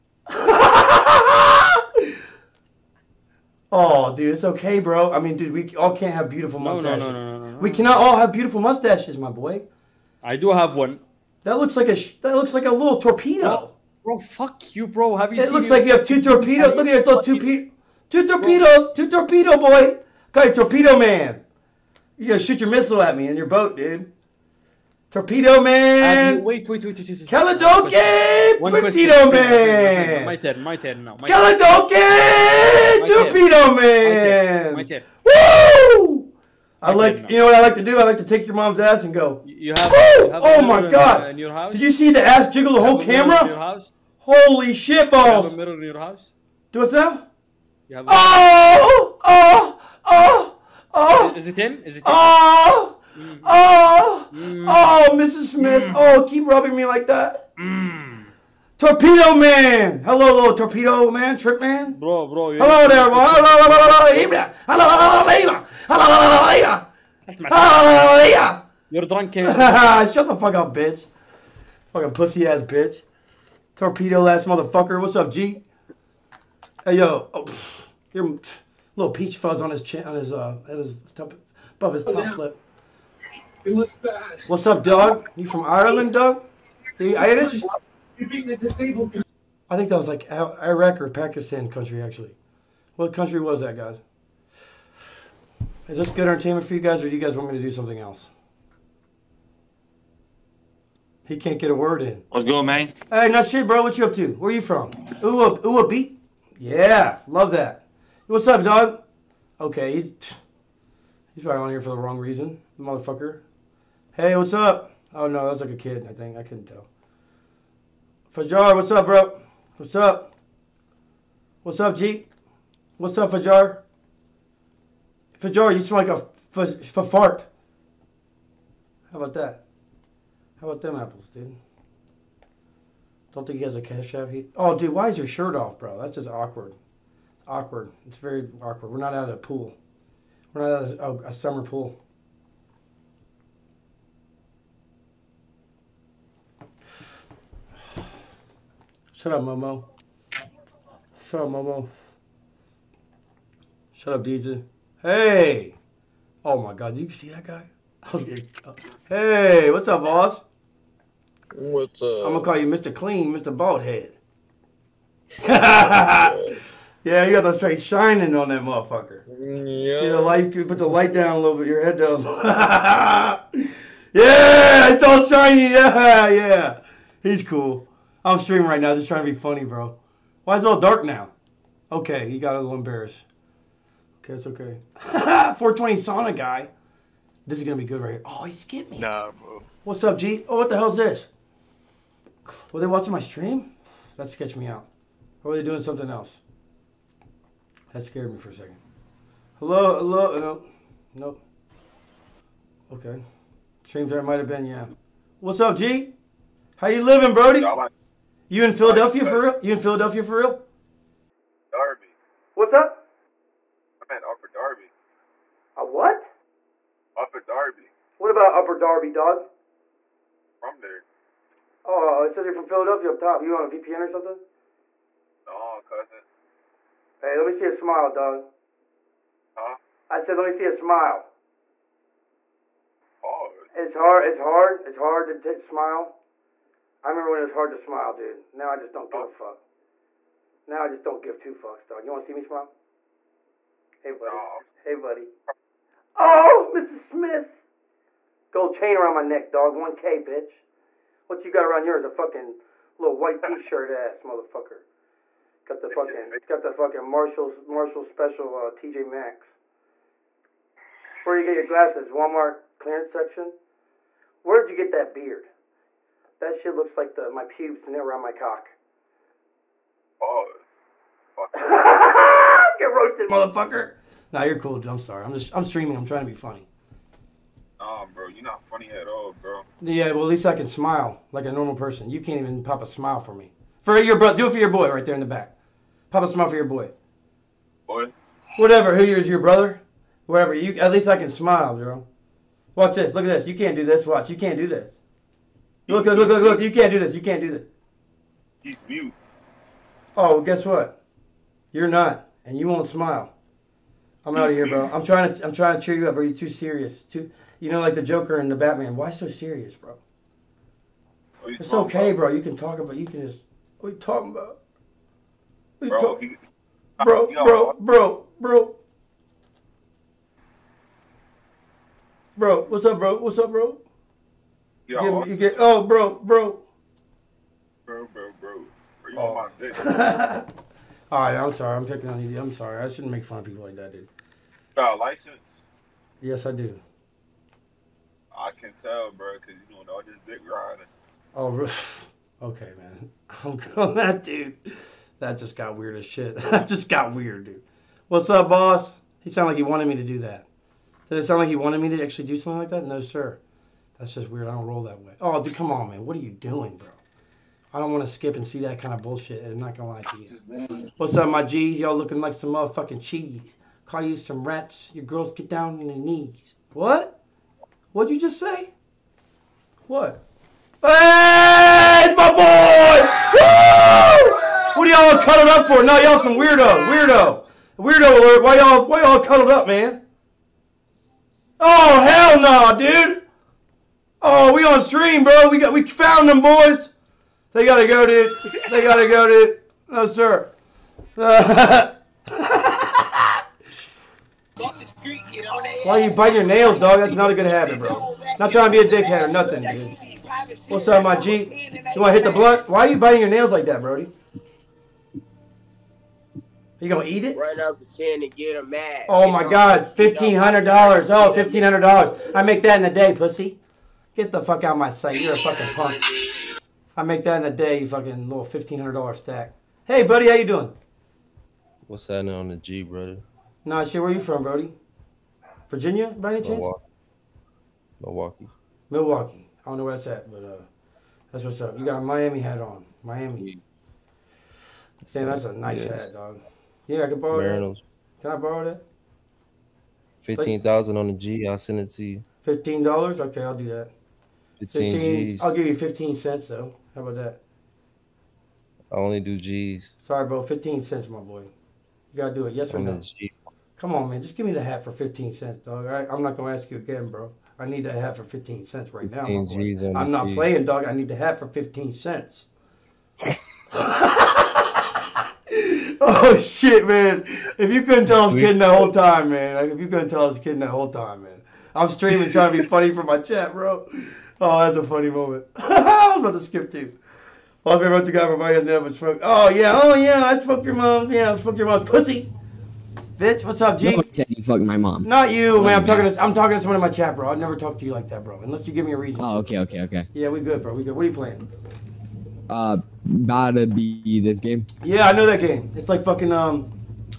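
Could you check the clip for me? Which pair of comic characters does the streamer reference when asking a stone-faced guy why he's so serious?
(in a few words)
the Joker and the Batman.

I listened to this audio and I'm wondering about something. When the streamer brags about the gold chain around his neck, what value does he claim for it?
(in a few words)
1K.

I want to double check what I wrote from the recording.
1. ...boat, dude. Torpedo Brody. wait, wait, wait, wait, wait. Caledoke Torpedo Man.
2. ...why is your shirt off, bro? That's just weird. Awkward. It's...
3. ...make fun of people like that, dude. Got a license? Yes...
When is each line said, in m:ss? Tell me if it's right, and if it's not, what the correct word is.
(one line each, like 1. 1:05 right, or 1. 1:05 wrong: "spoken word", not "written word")
1. 0:23 wrong: "Man", not "Brody"
2. 2:14 wrong: "awkward", not "weird"
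3. 5:33 right.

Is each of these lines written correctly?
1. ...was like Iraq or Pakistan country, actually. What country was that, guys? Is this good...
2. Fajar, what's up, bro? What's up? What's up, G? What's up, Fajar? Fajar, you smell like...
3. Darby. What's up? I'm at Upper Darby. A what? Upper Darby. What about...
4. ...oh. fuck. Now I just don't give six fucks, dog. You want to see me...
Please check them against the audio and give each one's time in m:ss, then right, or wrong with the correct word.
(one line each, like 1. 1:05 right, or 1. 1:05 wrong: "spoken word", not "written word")
1. 1:29 right
2. 1:58 right
3. 3:31 right
4. 3:59 wrong: "two", not "six".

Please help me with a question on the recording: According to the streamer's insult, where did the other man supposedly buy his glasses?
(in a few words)
Walmart clearance section.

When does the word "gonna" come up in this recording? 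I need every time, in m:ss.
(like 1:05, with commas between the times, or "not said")
2:42, 3:07, 5:59, 6:46, 7:36.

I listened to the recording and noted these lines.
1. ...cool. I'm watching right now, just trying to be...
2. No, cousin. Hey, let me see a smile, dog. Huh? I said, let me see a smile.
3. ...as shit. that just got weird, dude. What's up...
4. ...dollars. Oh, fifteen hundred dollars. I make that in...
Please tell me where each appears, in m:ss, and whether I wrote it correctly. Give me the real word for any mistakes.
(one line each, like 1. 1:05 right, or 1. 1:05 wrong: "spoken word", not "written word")
1. 2:57 wrong: "streaming", not "watching"
2. 3:45 right
3. 5:45 right
4. 6:50 right.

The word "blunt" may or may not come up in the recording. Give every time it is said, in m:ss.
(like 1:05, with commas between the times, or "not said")
6:42.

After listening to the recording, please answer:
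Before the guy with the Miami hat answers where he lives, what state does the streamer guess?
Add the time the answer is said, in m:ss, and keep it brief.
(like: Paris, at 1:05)
Virginia, at 7:05.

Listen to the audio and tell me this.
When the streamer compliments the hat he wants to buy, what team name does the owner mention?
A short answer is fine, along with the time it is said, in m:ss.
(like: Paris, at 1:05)
Mariners, at 7:17.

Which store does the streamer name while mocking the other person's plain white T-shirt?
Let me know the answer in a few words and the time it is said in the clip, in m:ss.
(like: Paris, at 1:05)
TJ Maxx, at 4:18.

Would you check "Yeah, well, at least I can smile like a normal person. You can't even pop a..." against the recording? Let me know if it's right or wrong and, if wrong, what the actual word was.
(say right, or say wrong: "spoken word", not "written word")
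right.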